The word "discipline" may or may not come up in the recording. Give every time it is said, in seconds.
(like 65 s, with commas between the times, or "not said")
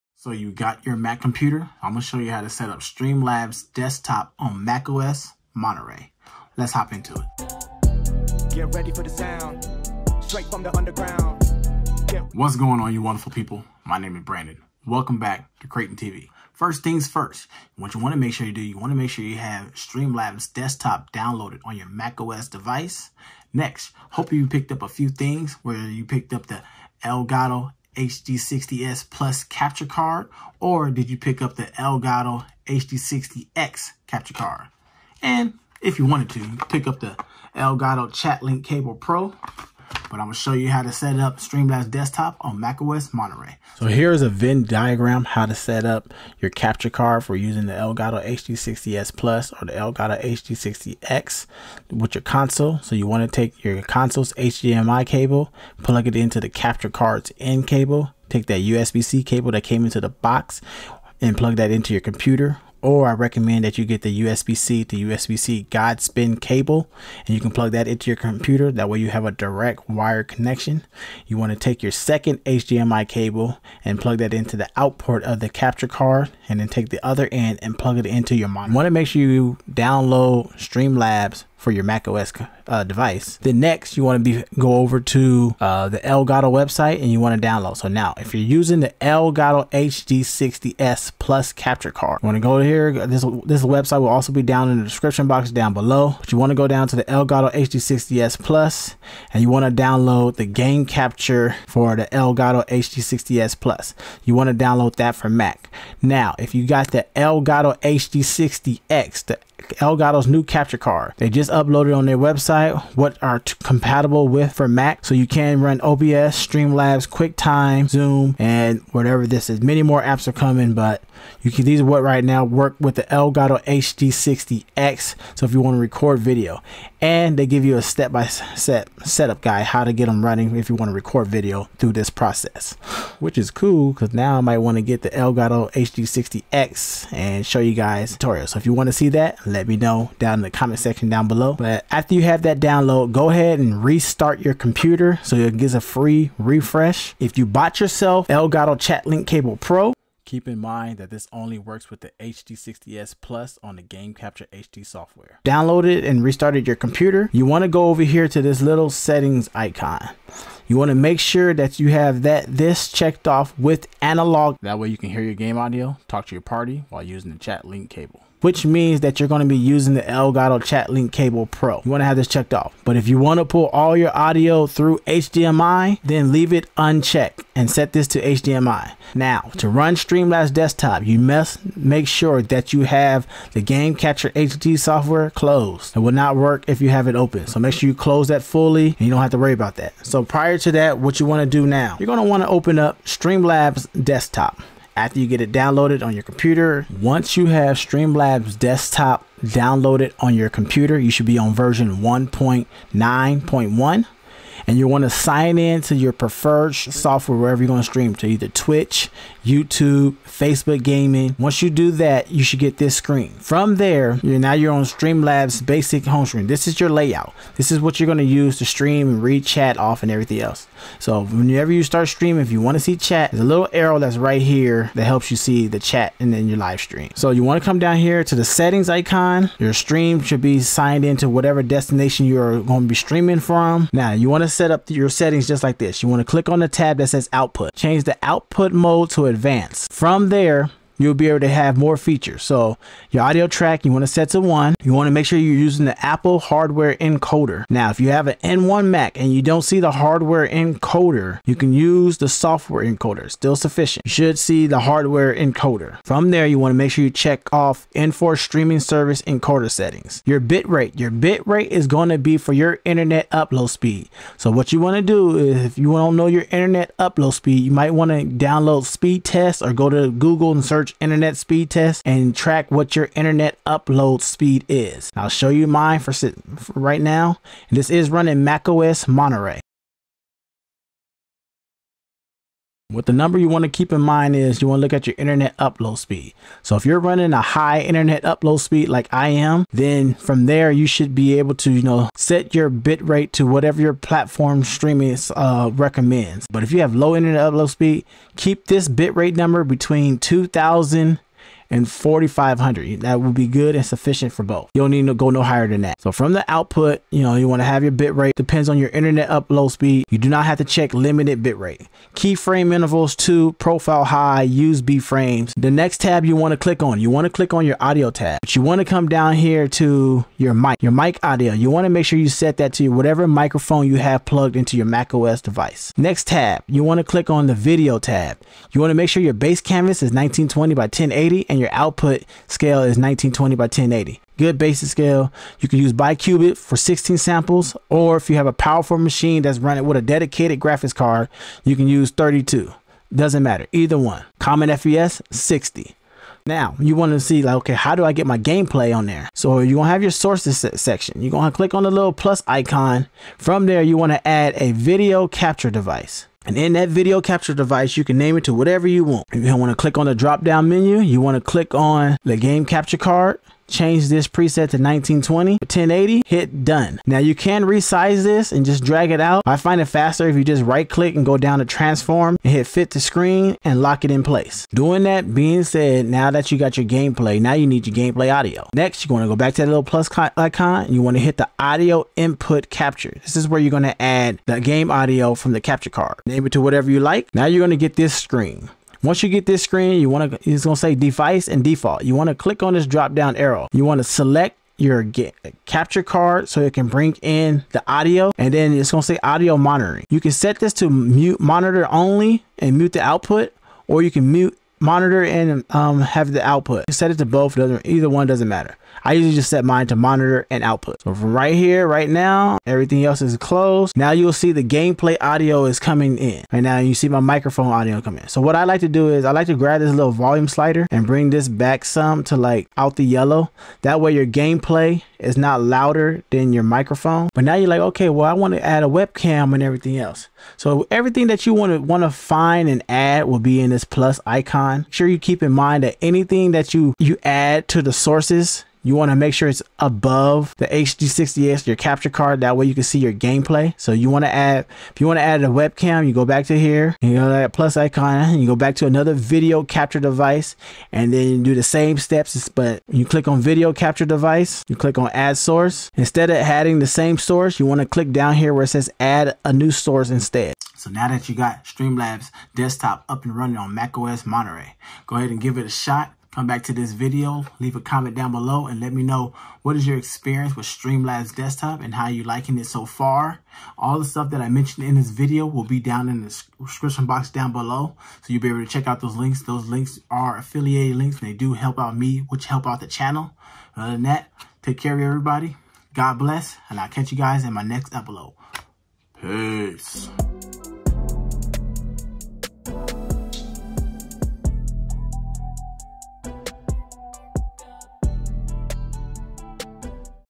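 not said.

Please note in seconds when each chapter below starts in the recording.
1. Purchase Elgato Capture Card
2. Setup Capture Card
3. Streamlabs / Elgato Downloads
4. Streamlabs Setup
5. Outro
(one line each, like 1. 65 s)
1. 25 s
2. 46 s
3. 85 s
4. 194 s
5. 460 s.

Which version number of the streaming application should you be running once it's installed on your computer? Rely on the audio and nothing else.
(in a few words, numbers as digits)
1.9.1.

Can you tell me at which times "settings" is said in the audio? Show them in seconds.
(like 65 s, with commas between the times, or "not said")
158 s, 228 s, 235 s, 259 s.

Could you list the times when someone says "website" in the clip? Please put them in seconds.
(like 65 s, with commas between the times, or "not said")
86 s, 93 s, 112 s.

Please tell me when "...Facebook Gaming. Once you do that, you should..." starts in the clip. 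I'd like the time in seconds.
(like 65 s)
210 s.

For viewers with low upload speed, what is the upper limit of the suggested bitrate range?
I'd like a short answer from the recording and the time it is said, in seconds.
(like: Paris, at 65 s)
4,500, at 301 s.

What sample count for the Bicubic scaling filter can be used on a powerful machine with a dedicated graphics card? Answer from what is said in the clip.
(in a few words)
32.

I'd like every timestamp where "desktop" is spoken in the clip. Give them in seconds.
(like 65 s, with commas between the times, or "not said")
3 s, 20 s, 41 s, 180 s, 194 s, 198 s, 462 s, 471 s.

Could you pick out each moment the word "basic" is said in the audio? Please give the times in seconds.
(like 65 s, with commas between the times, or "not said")
215 s, 334 s.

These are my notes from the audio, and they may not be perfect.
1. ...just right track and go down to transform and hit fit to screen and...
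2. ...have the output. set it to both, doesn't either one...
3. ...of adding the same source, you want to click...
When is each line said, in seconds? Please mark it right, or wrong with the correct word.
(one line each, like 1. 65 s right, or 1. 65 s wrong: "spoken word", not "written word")
1. 370 s wrong: "click", not "track"
2. 406 s right
3. 456 s right.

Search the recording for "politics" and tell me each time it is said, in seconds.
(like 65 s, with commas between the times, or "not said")
not said.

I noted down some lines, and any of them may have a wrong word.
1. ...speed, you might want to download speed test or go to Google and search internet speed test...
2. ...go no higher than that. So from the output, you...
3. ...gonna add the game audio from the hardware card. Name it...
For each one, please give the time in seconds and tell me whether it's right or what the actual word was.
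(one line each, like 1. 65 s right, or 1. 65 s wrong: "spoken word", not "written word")
1. 267 s right
2. 305 s right
3. 383 s wrong: "capture", not "hardware".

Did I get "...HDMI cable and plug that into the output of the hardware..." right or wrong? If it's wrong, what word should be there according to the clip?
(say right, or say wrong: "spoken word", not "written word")
wrong: "capture", not "hardware".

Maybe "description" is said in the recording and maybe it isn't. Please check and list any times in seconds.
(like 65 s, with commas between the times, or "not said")
94 s, 476 s.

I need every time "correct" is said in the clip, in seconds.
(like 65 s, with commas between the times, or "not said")
not said.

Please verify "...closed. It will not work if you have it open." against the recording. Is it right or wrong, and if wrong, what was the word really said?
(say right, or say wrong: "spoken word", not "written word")
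right.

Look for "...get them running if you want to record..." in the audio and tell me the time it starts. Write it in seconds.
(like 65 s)
129 s.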